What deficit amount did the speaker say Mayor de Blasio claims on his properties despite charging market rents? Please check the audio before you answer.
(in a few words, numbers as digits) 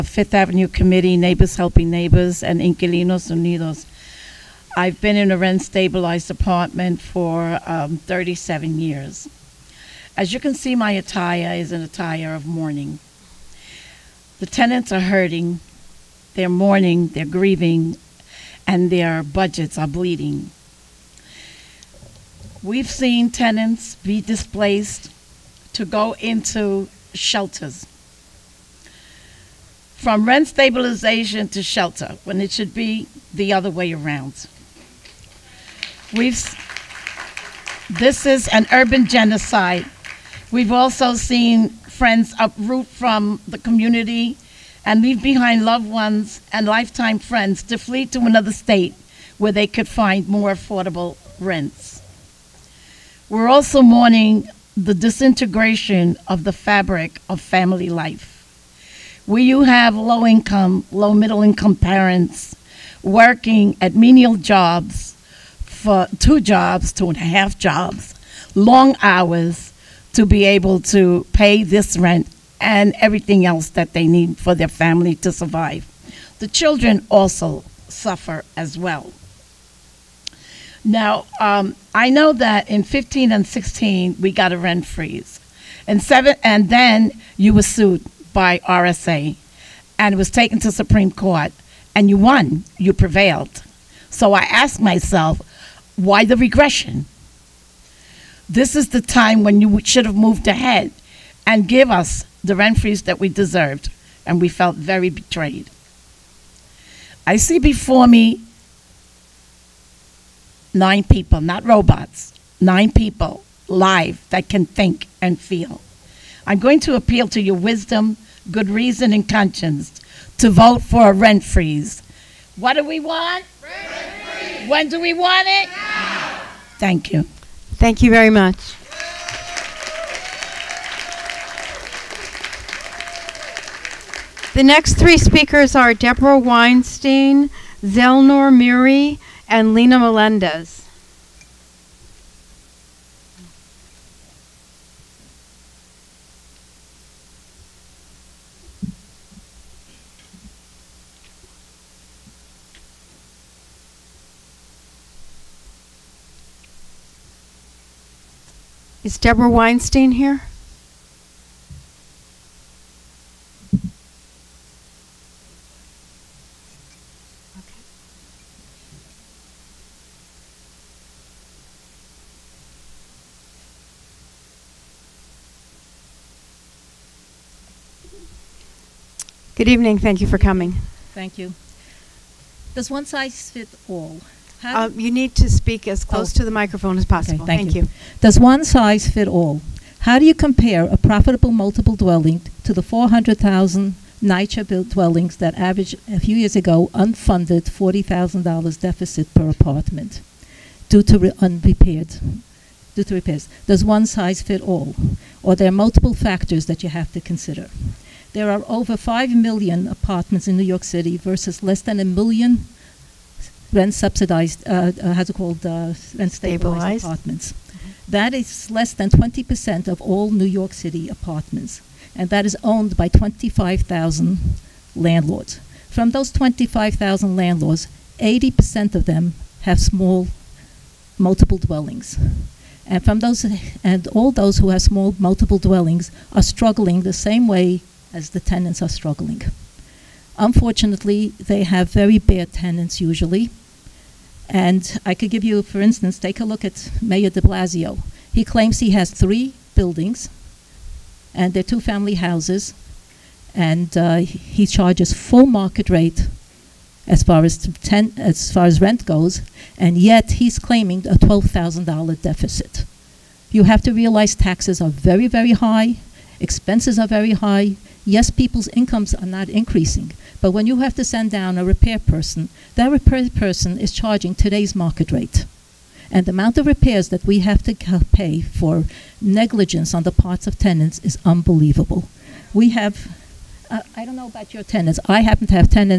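$12,000.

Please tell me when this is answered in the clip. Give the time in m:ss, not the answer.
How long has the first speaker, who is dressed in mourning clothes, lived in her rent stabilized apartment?
0:07.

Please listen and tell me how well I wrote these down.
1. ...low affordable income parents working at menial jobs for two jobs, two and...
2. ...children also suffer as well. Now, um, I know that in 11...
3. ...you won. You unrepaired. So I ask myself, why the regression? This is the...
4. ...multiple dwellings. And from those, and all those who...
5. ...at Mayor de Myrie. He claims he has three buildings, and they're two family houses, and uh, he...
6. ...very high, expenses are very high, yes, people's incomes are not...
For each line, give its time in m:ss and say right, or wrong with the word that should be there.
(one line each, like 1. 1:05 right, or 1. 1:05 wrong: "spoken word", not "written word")
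1. 1:00 wrong: "middle", not "affordable"
2. 1:16 wrong: "15", not "11"
3. 1:32 wrong: "prevailed", not "unrepaired"
4. 3:51 right
5. 4:06 wrong: "Blasio", not "Myrie"
6. 4:25 right.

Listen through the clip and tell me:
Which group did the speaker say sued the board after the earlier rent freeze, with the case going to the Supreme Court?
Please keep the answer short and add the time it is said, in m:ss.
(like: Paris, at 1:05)
RSA, at 1:28.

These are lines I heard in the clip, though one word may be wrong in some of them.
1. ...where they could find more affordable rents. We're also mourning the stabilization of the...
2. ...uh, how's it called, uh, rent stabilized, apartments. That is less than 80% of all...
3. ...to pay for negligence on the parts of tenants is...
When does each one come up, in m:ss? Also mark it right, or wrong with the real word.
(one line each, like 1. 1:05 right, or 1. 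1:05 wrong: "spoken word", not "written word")
1. 0:49 wrong: "disintegration", not "stabilization"
2. 3:35 wrong: "20", not "80"
3. 4:37 right.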